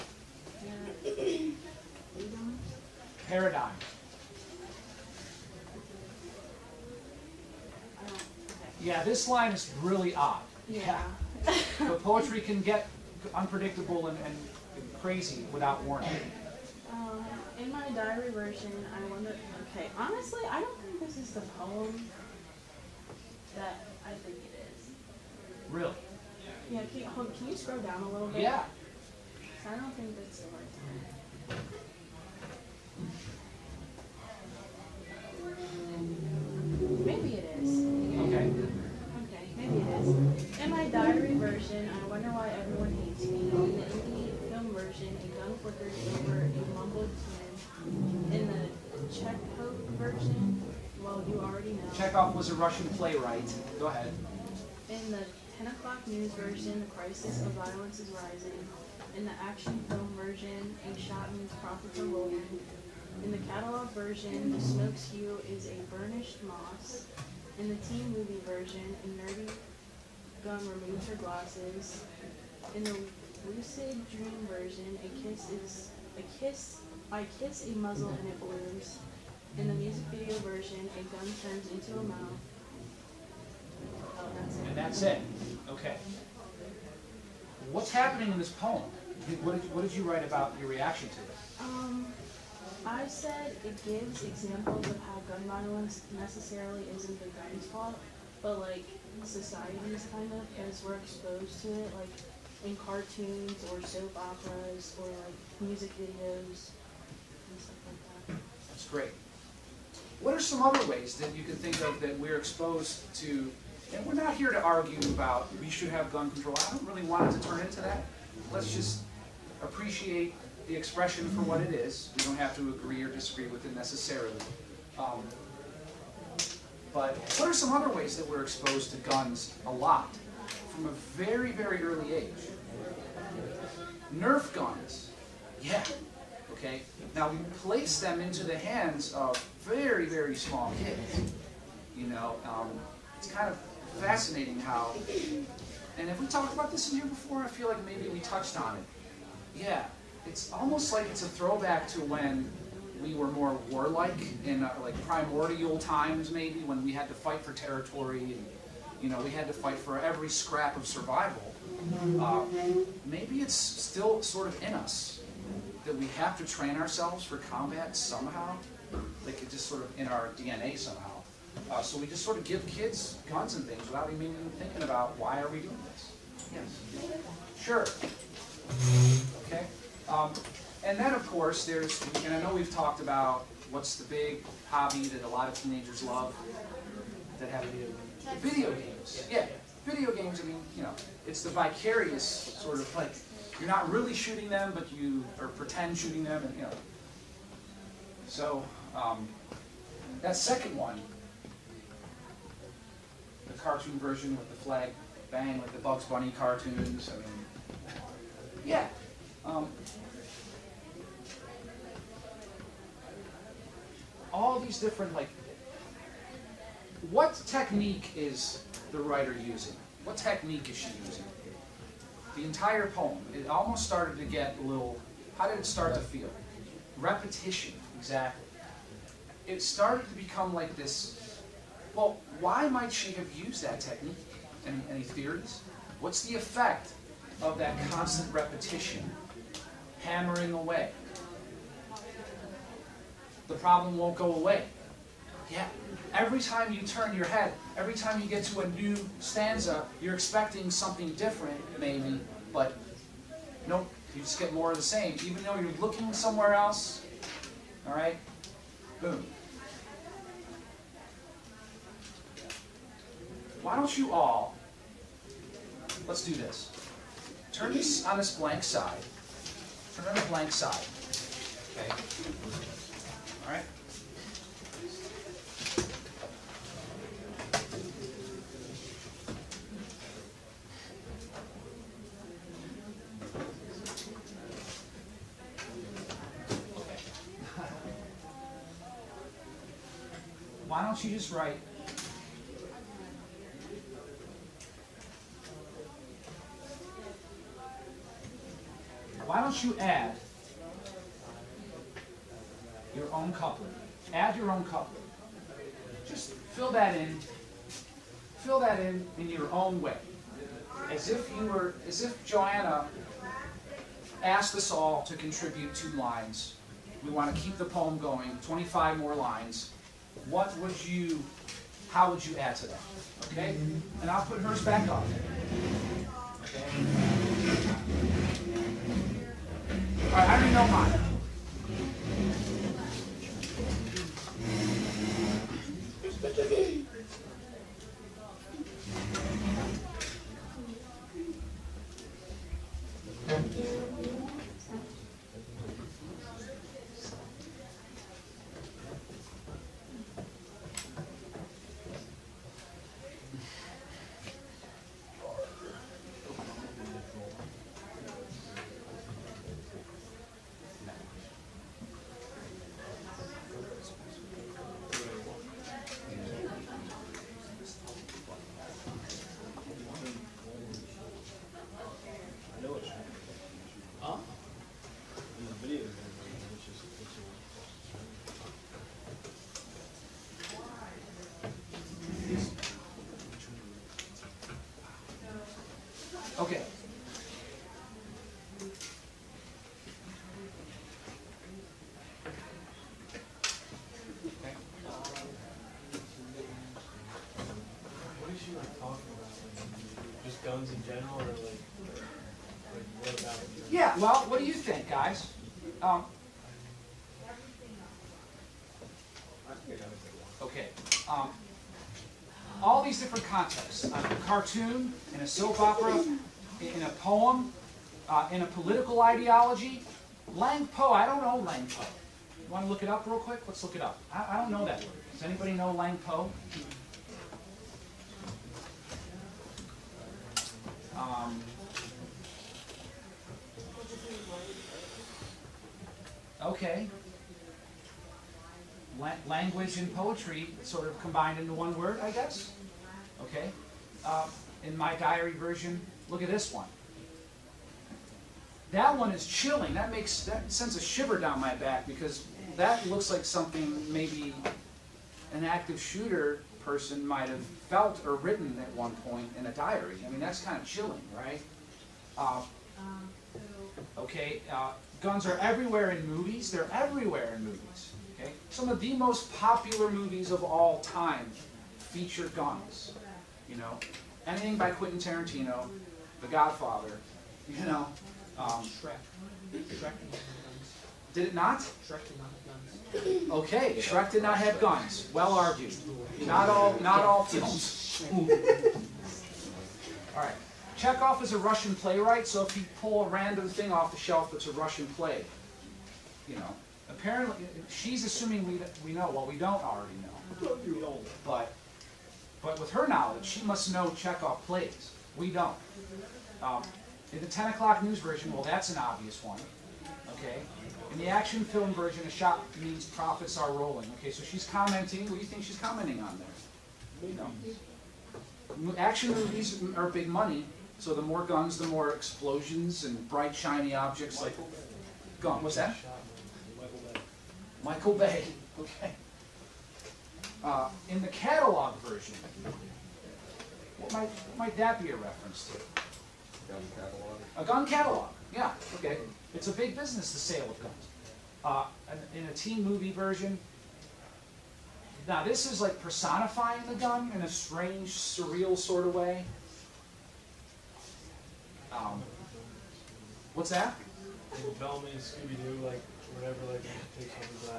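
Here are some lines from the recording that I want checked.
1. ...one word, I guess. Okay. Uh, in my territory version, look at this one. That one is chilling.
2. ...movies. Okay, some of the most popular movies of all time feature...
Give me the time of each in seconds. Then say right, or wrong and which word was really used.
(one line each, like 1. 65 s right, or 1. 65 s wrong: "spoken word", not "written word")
1. 441 s wrong: "diary", not "territory"
2. 467 s right.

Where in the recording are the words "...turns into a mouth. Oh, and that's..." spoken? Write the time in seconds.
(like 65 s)
81 s.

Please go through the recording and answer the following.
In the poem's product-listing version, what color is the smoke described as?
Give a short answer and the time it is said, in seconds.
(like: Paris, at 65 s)
burnished moss, at 65 s.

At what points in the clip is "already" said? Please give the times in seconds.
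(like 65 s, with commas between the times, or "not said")
51 s, 330 s, 499 s.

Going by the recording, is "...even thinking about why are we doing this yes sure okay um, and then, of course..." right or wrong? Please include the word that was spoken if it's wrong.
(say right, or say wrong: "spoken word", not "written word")
right.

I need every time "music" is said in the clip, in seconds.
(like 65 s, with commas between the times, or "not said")
79 s, 105 s.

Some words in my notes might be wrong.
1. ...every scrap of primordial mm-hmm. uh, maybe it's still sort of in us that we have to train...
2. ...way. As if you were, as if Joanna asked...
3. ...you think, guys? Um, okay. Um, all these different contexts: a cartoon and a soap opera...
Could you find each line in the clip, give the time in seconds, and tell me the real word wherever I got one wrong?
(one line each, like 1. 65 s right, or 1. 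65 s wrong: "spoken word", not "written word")
1. 159 s wrong: "survival", not "primordial"
2. 309 s right
3. 404 s right.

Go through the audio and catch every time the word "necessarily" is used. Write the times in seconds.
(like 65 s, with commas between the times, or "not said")
96 s, 123 s.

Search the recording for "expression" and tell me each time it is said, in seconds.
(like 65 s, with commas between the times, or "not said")
120 s.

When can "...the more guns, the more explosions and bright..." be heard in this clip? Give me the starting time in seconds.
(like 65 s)
520 s.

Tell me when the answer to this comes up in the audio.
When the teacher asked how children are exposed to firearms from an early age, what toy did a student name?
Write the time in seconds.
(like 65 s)
134 s.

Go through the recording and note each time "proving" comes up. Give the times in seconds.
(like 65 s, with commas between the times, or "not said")
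not said.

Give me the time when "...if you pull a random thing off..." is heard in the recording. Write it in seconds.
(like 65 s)
492 s.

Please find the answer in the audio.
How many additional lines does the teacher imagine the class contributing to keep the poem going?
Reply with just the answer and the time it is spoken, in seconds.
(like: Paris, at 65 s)
25, at 318 s.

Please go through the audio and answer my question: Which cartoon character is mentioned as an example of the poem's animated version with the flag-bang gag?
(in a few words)
Bugs Bunny.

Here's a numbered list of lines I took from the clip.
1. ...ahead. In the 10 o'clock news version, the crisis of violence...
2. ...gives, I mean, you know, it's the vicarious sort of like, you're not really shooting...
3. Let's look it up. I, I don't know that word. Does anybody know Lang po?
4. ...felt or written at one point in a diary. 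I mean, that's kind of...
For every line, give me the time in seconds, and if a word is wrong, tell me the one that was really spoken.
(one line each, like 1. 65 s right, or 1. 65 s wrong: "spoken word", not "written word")
1. 53 s right
2. 190 s wrong: "games", not "gives"
3. 423 s right
4. 457 s right.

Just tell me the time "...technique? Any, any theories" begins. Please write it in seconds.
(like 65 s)
233 s.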